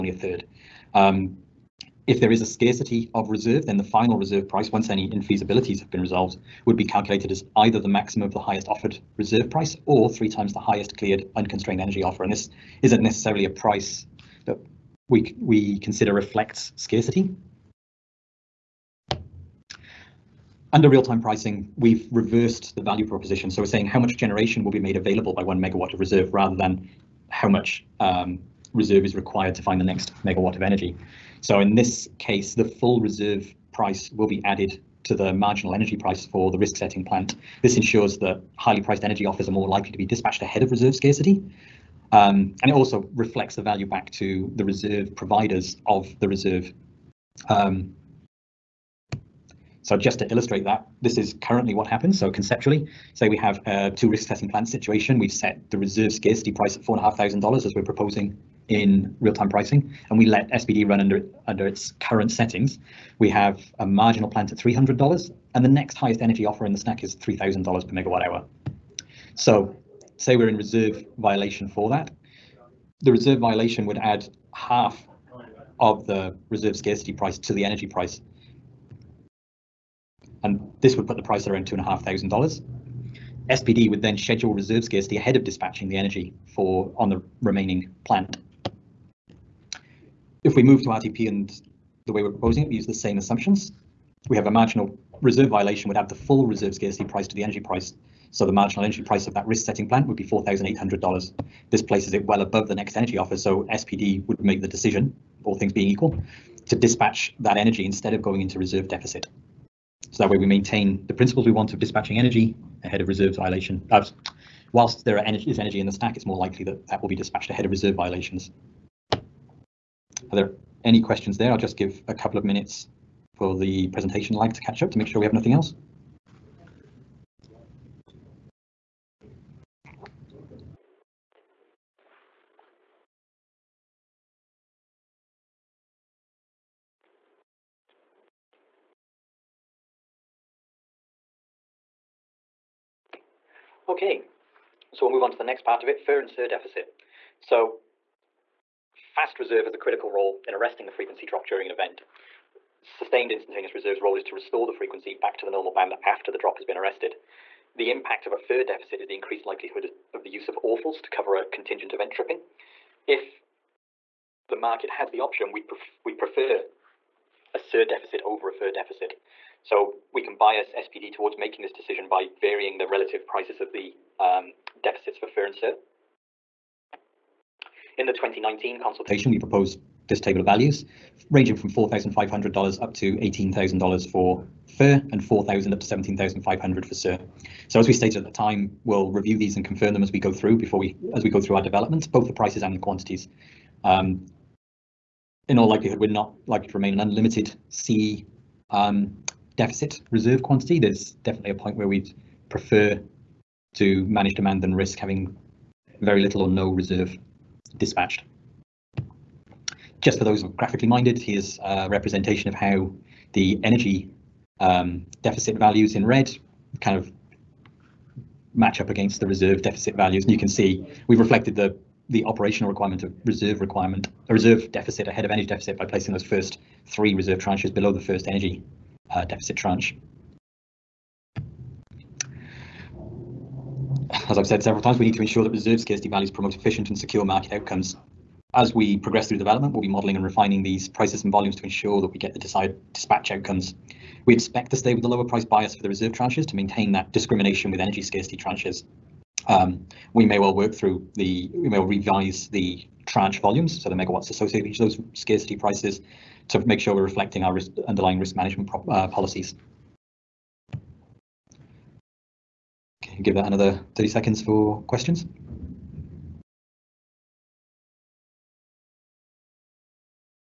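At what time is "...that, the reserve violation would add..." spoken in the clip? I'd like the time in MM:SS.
01:11.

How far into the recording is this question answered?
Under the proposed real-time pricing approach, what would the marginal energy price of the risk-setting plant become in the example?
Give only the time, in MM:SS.
01:40.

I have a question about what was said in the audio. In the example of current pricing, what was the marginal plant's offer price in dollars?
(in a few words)
$300.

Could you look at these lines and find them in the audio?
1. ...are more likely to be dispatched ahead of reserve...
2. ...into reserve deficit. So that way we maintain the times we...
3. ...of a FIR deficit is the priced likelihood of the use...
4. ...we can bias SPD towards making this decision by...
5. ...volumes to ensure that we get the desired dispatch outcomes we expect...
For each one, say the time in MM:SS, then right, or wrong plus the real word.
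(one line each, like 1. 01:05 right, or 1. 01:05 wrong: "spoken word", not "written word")
1. 00:39 right
2. 01:48 wrong: "principles", not "times"
3. 02:38 wrong: "increased", not "priced"
4. 02:50 right
5. 04:01 right.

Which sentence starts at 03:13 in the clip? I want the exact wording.
Um, in all likelihood, we're not likely to remain an unlimited C um, deficit reserve quantity.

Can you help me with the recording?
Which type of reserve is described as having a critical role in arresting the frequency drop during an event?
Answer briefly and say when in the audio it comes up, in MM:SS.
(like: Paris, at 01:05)
Fast reserve, at 02:28.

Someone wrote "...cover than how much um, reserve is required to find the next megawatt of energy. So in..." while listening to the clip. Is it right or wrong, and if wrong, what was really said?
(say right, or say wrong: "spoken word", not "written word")
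wrong: "rather", not "cover".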